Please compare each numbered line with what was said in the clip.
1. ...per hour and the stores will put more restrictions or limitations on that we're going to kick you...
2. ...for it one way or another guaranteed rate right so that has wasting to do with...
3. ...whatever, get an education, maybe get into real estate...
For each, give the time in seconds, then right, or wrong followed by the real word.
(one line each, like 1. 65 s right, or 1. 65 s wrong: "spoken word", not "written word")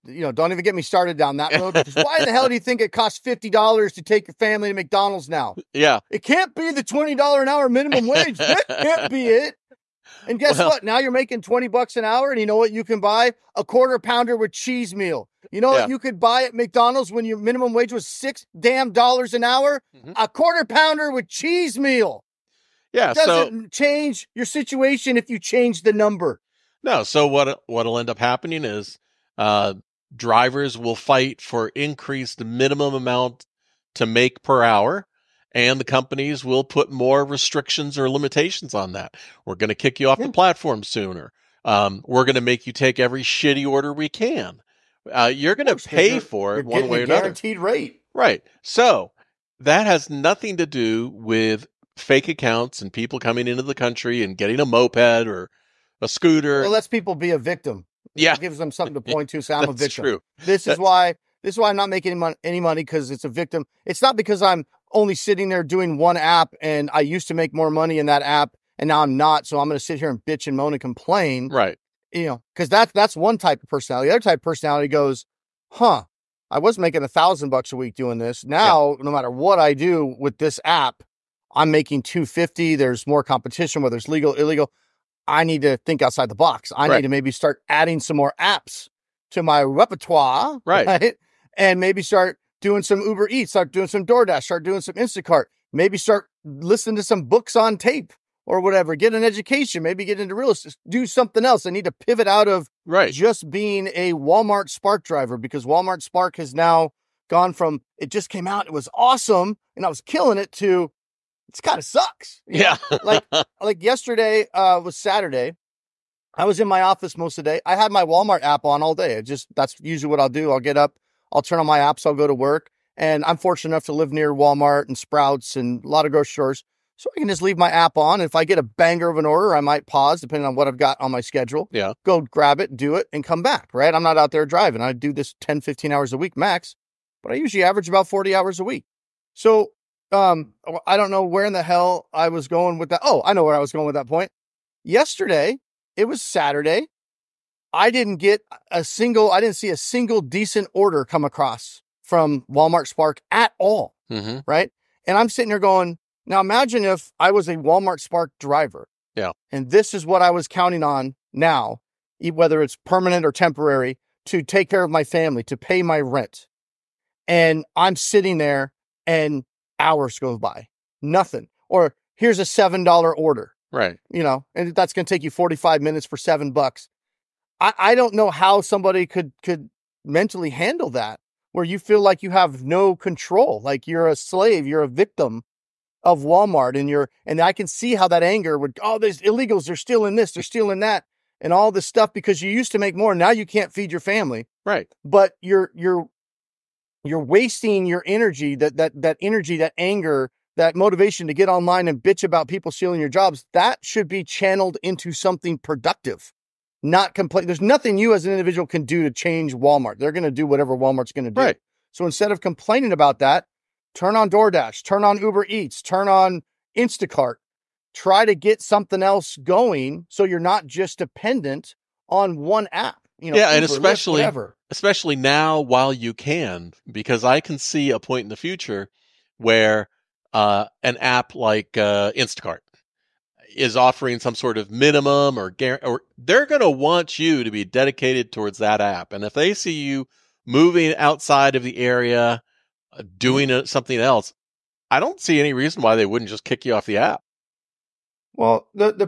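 1. 34 s wrong: "companies", not "stores"
2. 46 s wrong: "nothing", not "wasting"
3. 98 s right.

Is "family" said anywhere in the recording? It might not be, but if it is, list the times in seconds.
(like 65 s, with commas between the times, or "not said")
4 s, 165 s, 193 s.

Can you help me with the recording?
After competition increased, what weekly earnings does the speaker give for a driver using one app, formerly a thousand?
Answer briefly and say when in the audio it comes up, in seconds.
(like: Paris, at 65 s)
250, at 82 s.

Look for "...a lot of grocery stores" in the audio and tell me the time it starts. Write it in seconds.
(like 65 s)
125 s.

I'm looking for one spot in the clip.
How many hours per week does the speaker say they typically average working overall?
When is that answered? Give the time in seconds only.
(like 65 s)
138 s.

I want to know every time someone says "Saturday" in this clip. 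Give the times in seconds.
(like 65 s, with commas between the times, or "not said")
114 s, 146 s.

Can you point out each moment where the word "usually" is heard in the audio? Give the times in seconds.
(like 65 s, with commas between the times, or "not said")
119 s, 137 s.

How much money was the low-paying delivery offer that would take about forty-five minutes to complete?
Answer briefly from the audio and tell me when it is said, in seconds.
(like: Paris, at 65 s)
$7, at 172 s.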